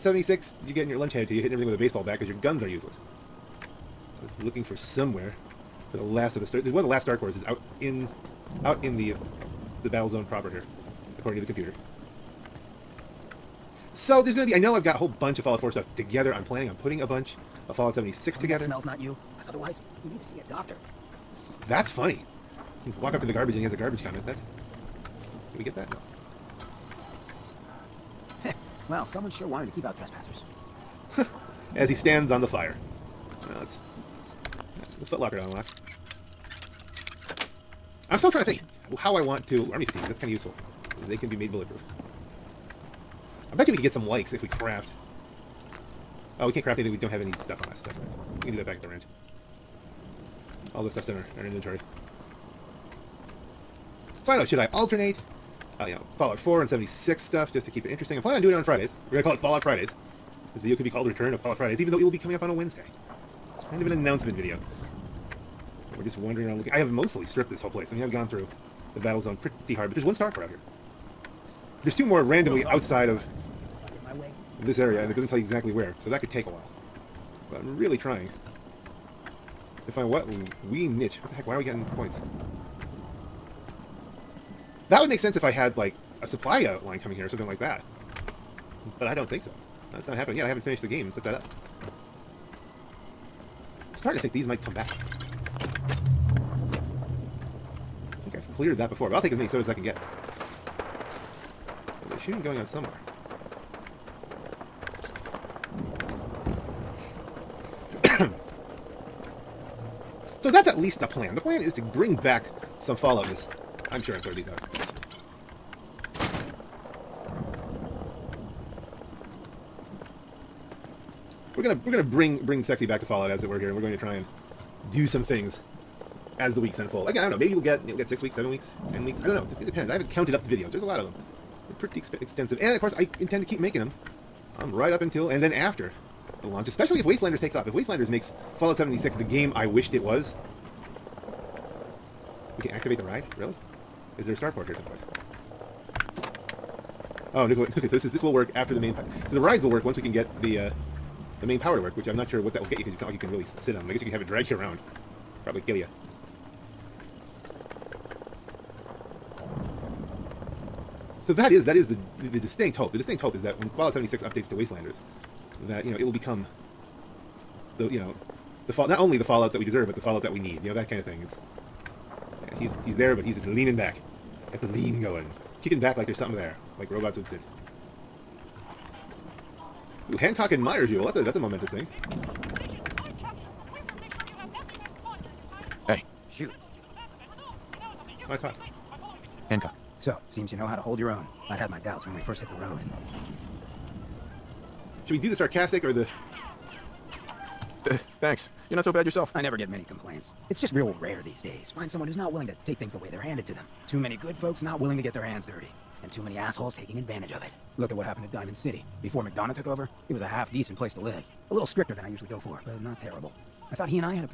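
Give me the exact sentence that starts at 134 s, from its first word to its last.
I'm right up until and then after the launch, especially if Wastelanders takes off.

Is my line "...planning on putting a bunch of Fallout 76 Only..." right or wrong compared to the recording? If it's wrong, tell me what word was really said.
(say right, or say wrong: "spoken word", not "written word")
right.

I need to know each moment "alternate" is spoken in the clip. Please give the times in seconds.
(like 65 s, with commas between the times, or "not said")
54 s.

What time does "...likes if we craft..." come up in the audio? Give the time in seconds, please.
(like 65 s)
44 s.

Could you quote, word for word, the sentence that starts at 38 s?
to think how I want to...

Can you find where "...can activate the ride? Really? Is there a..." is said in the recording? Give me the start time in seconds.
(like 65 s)
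142 s.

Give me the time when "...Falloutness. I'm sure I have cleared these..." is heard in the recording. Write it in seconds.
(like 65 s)
112 s.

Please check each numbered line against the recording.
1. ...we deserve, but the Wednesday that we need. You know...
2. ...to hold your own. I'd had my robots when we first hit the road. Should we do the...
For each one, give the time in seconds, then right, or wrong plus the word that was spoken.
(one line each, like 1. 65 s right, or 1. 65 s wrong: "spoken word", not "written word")
1. 169 s wrong: "Fallout", not "Wednesday"
2. 190 s wrong: "doubts", not "robots".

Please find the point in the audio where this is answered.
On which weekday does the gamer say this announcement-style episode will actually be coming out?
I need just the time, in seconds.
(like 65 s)
62 s.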